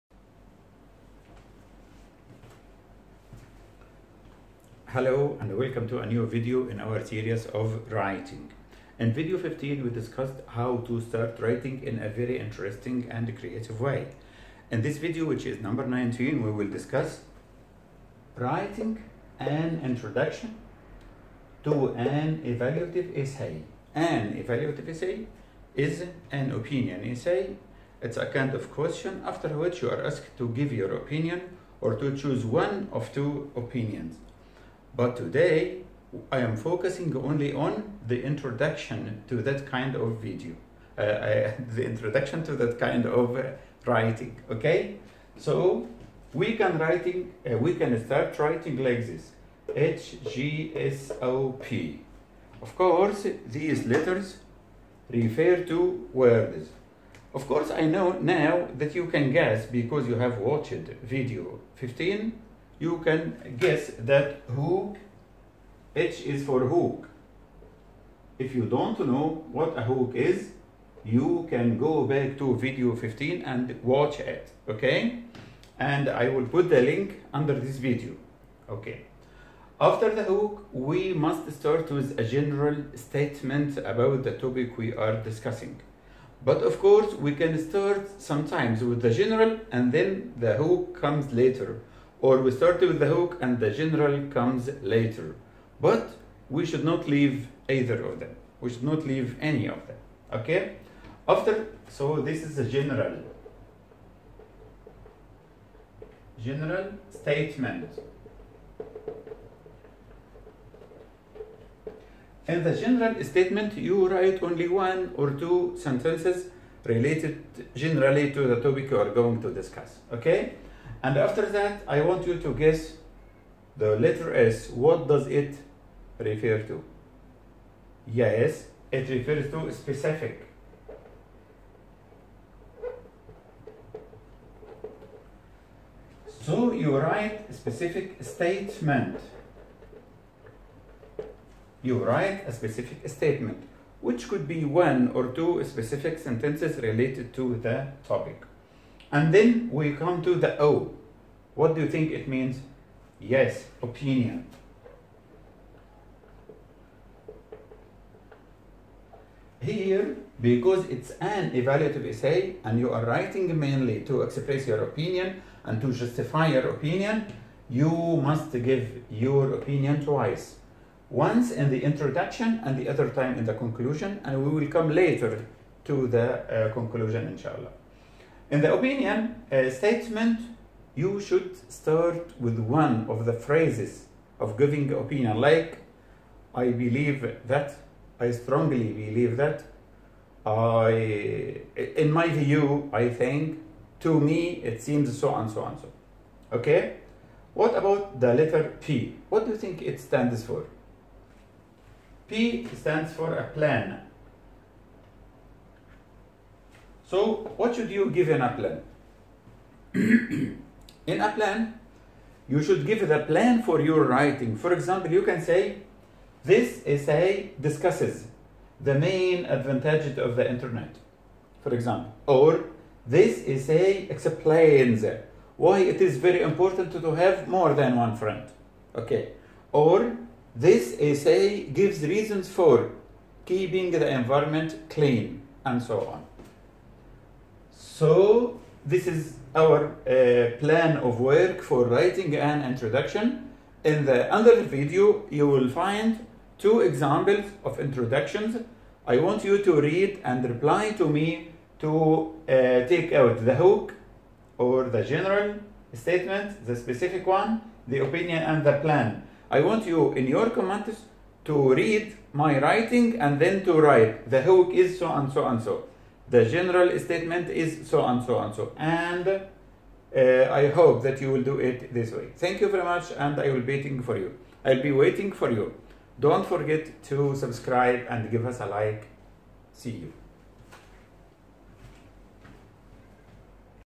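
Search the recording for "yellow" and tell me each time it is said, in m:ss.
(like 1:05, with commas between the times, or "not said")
not said.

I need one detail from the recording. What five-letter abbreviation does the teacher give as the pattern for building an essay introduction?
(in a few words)
HGSOP.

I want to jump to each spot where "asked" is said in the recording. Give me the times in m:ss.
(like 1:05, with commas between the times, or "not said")
0:30.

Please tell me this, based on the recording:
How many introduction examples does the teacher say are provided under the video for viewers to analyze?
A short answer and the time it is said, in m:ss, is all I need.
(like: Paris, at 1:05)
2, at 4:06.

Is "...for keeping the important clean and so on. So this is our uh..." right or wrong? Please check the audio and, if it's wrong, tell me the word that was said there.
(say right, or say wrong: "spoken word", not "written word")
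wrong: "environment", not "important".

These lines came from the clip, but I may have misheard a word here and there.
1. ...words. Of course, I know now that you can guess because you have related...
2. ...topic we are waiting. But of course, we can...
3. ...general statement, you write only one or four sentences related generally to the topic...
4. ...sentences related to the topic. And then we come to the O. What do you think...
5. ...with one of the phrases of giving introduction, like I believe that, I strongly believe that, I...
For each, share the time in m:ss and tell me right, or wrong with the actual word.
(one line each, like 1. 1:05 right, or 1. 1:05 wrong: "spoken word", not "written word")
1. 0:56 wrong: "watched", not "related"
2. 1:24 wrong: "discussing", not "waiting"
3. 1:52 wrong: "two", not "four"
4. 2:26 right
5. 3:02 wrong: "opinion", not "introduction".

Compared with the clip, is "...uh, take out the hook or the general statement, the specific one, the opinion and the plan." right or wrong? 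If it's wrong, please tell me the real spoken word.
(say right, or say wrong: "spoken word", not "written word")
right.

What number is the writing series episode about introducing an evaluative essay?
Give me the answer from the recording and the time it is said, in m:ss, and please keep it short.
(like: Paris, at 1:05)
19, at 0:15.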